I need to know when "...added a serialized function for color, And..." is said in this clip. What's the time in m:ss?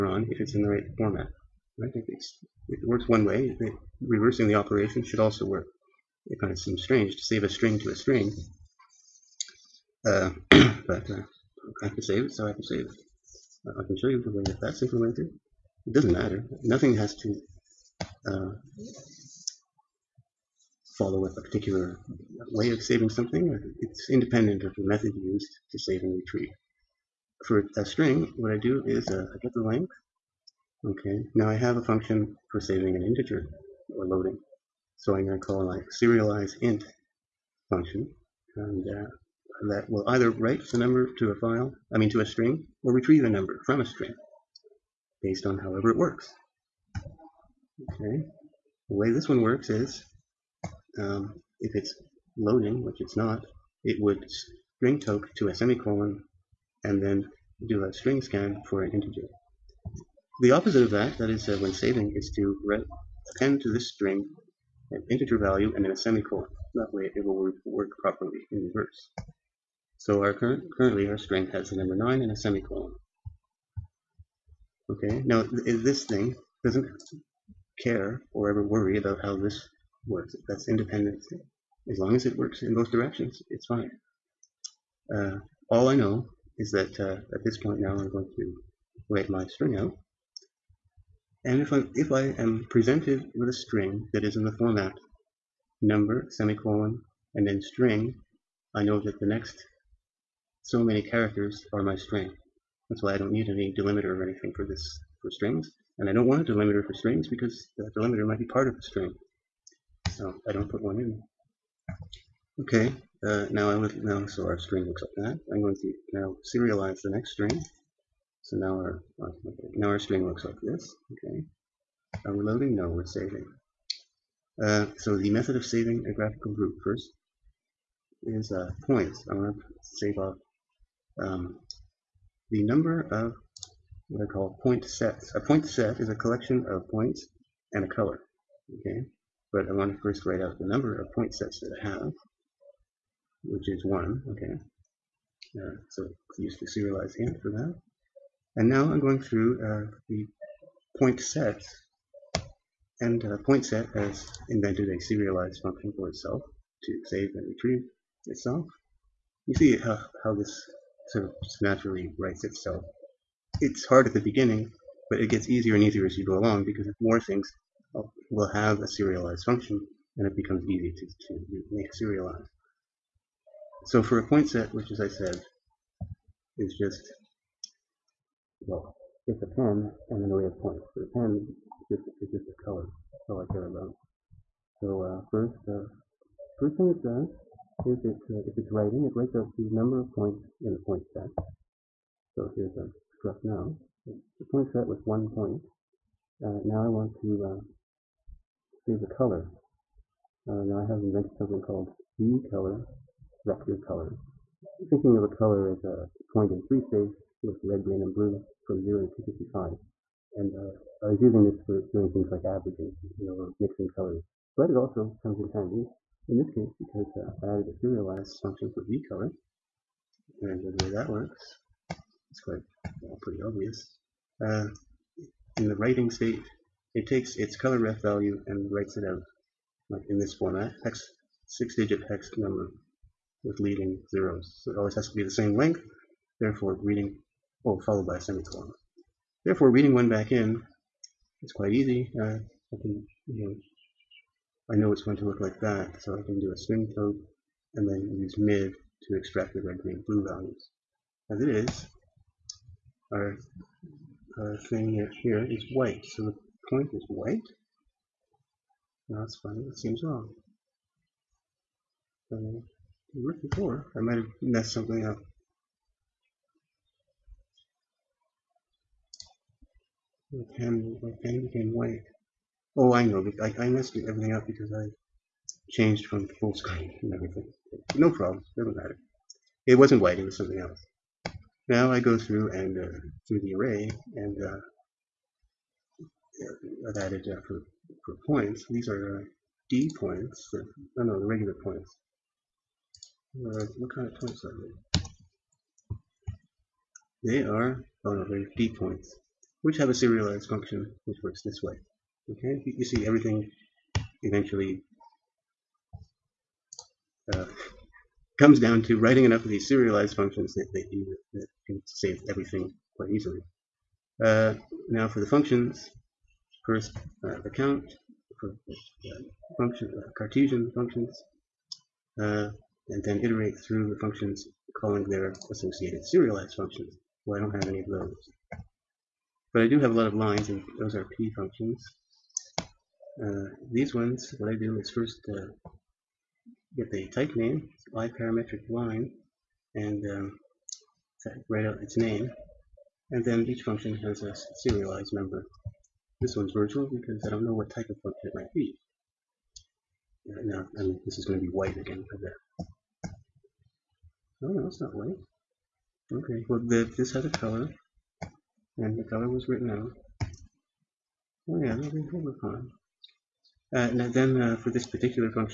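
3:37.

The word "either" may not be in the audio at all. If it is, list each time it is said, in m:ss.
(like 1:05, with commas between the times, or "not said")
0:40.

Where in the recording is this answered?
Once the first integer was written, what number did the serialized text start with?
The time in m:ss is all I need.
1:11.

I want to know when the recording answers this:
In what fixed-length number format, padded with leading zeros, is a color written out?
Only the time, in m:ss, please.
3:51.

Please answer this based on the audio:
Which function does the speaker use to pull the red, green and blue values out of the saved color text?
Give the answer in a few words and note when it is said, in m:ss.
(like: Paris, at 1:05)
mid, at 4:08.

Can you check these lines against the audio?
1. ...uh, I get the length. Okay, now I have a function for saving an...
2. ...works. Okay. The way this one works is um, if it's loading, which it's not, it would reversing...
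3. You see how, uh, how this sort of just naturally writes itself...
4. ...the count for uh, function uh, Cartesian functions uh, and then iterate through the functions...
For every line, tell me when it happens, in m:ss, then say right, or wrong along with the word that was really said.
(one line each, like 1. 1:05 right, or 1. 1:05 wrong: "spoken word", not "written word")
1. 0:29 right
2. 0:45 wrong: "string", not "reversing"
3. 2:39 right
4. 5:17 right.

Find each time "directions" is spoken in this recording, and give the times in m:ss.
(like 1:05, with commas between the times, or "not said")
1:22.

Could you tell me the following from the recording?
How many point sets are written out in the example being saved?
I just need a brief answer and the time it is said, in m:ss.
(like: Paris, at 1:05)
1, at 2:23.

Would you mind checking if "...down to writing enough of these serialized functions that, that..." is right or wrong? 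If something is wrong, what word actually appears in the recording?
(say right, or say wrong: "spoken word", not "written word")
right.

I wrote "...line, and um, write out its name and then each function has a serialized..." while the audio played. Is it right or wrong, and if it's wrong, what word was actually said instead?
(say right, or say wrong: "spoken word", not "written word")
right.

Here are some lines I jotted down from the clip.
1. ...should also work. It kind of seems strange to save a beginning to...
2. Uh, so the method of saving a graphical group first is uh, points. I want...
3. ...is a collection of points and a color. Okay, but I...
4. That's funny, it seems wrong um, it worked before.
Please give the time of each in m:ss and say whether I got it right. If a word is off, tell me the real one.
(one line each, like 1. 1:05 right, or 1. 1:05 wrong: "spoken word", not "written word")
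1. 0:05 wrong: "string", not "beginning"
2. 2:04 right
3. 2:15 right
4. 4:19 right.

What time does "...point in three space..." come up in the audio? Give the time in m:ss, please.
3:26.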